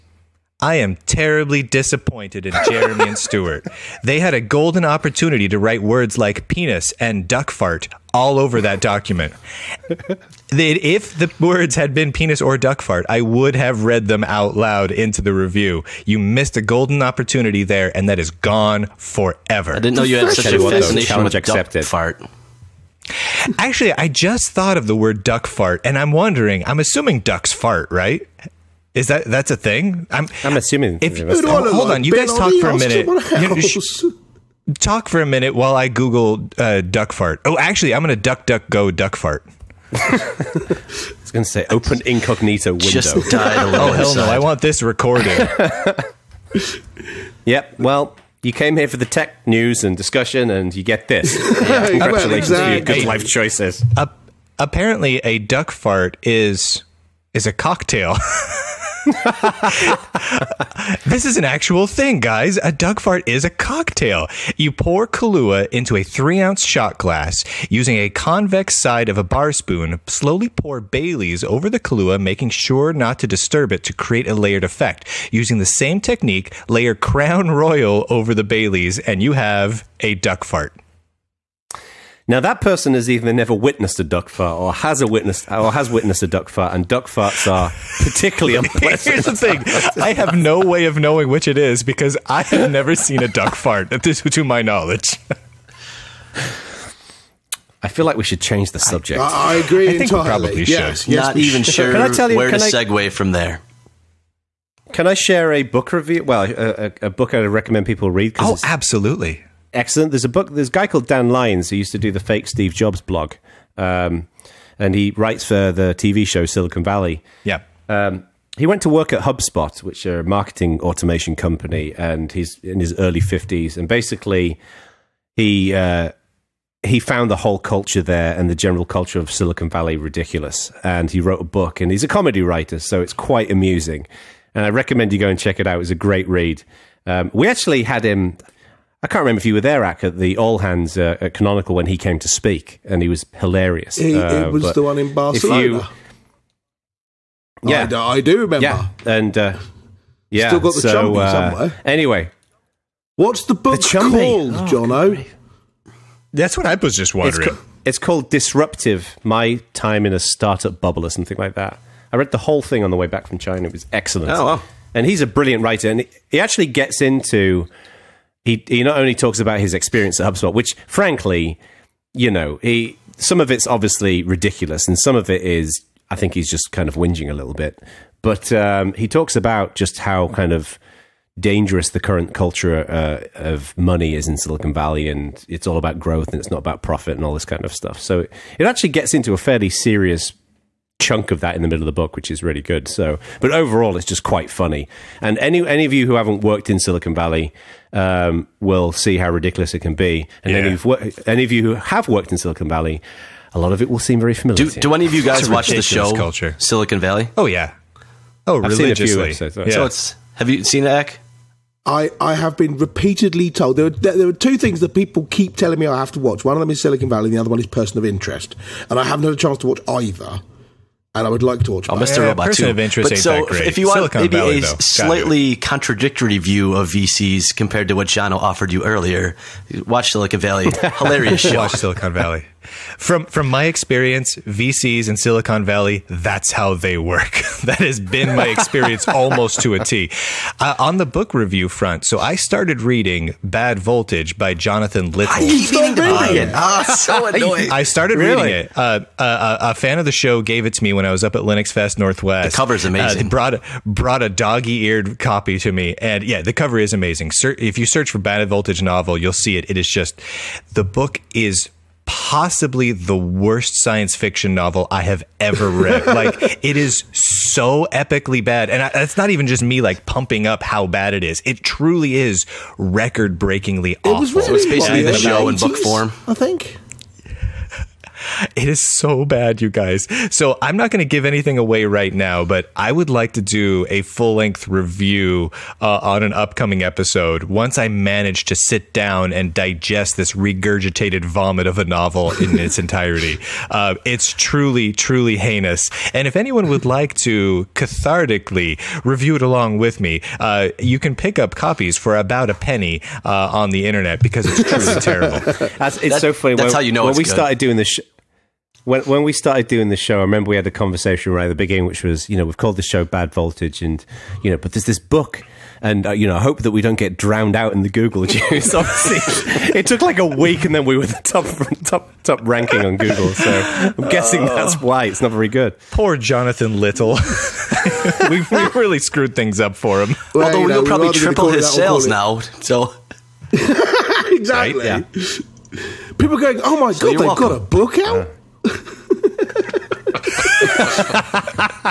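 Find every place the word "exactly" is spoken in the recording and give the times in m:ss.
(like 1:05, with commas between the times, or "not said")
0:52, 5:33.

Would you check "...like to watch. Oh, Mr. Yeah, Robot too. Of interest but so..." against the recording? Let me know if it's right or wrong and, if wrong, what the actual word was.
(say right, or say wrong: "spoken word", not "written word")
right.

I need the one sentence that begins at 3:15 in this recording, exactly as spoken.
And any any of you who haven't worked in Silicon Valley um, will see how ridiculous it can be.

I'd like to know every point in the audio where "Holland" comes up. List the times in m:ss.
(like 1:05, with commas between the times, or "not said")
not said.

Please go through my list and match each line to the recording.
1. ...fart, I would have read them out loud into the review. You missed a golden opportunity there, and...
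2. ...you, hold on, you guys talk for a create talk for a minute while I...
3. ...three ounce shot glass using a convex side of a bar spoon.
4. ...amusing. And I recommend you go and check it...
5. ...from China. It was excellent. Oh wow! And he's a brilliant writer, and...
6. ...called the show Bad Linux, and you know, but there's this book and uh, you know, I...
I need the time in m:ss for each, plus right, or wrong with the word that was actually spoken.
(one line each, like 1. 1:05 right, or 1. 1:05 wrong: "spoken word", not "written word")
1. 0:12 right
2. 0:31 wrong: "minute", not "create"
3. 1:06 right
4. 2:13 right
5. 2:43 right
6. 5:12 wrong: "Voltage", not "Linux".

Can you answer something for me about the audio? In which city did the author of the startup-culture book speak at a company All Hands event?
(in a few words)
Barcelona.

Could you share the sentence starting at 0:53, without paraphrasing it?
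Uh, apparently, a duck fart is is a cocktail.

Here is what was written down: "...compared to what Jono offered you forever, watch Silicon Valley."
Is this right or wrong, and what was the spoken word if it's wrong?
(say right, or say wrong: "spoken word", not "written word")
wrong: "earlier", not "forever".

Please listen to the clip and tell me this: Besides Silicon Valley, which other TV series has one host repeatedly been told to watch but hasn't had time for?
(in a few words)
Person of Interest.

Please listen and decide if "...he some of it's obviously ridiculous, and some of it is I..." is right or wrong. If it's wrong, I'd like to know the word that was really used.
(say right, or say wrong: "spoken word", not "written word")
right.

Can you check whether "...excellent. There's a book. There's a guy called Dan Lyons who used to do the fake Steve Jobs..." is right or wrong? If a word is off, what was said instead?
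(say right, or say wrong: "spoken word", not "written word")
right.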